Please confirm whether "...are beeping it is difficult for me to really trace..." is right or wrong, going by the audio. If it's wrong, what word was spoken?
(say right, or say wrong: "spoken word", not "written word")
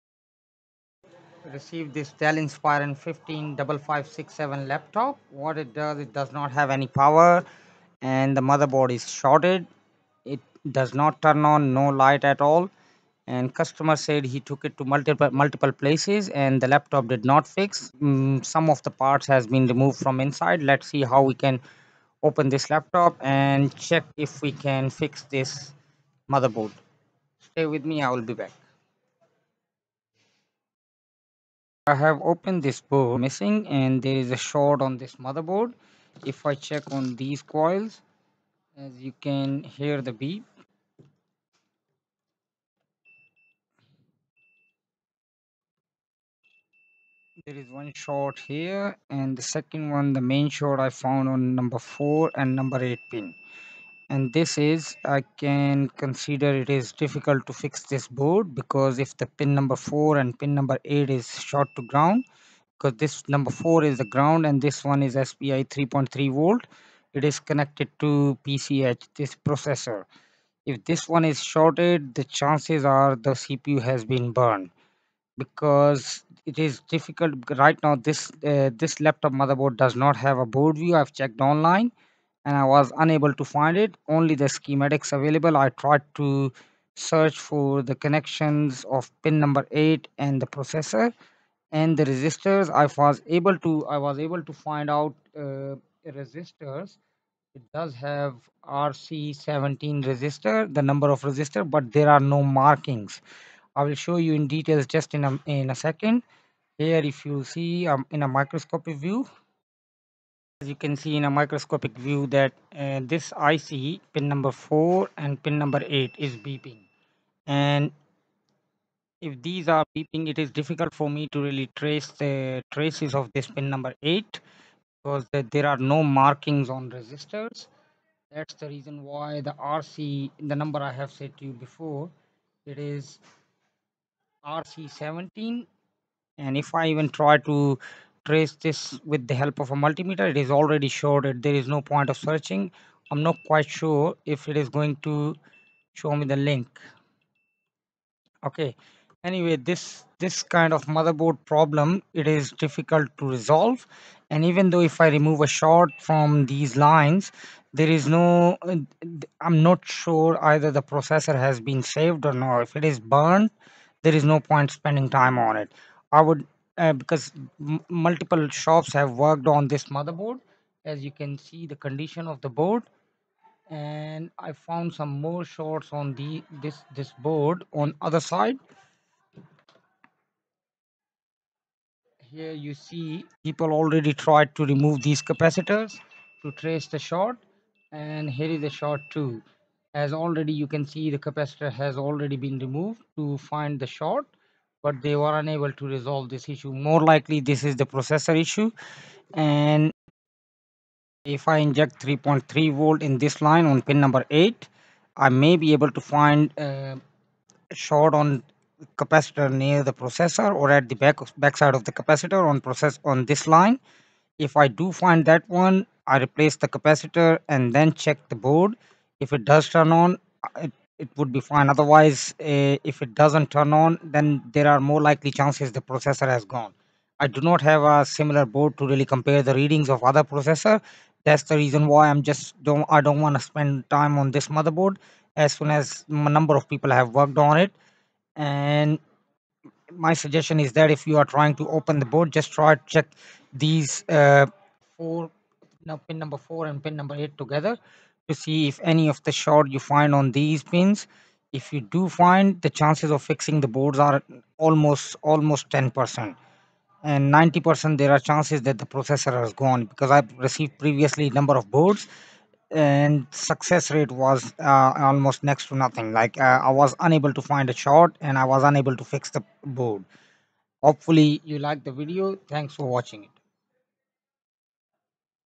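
right.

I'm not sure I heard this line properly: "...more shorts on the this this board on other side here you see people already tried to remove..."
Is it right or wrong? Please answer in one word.
right.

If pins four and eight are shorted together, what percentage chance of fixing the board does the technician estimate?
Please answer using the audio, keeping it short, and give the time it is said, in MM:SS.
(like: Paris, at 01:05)
10%, at 04:15.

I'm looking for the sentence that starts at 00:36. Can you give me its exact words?
If I check on these coils, as you can hear the beep.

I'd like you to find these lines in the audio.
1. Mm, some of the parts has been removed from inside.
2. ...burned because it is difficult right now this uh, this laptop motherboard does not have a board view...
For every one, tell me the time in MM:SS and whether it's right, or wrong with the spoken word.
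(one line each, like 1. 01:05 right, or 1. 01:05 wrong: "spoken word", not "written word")
1. 00:18 right
2. 01:14 right.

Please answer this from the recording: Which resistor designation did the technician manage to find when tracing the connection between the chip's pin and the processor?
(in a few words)
RC17.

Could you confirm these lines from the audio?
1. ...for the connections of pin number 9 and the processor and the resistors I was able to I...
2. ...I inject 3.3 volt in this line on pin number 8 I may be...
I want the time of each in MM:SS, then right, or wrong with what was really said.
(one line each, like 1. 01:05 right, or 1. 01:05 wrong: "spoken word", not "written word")
1. 01:27 wrong: "8", not "9"
2. 03:21 right.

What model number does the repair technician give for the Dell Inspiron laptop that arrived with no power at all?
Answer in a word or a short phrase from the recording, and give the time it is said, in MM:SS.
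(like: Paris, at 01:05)
155567, at 00:02.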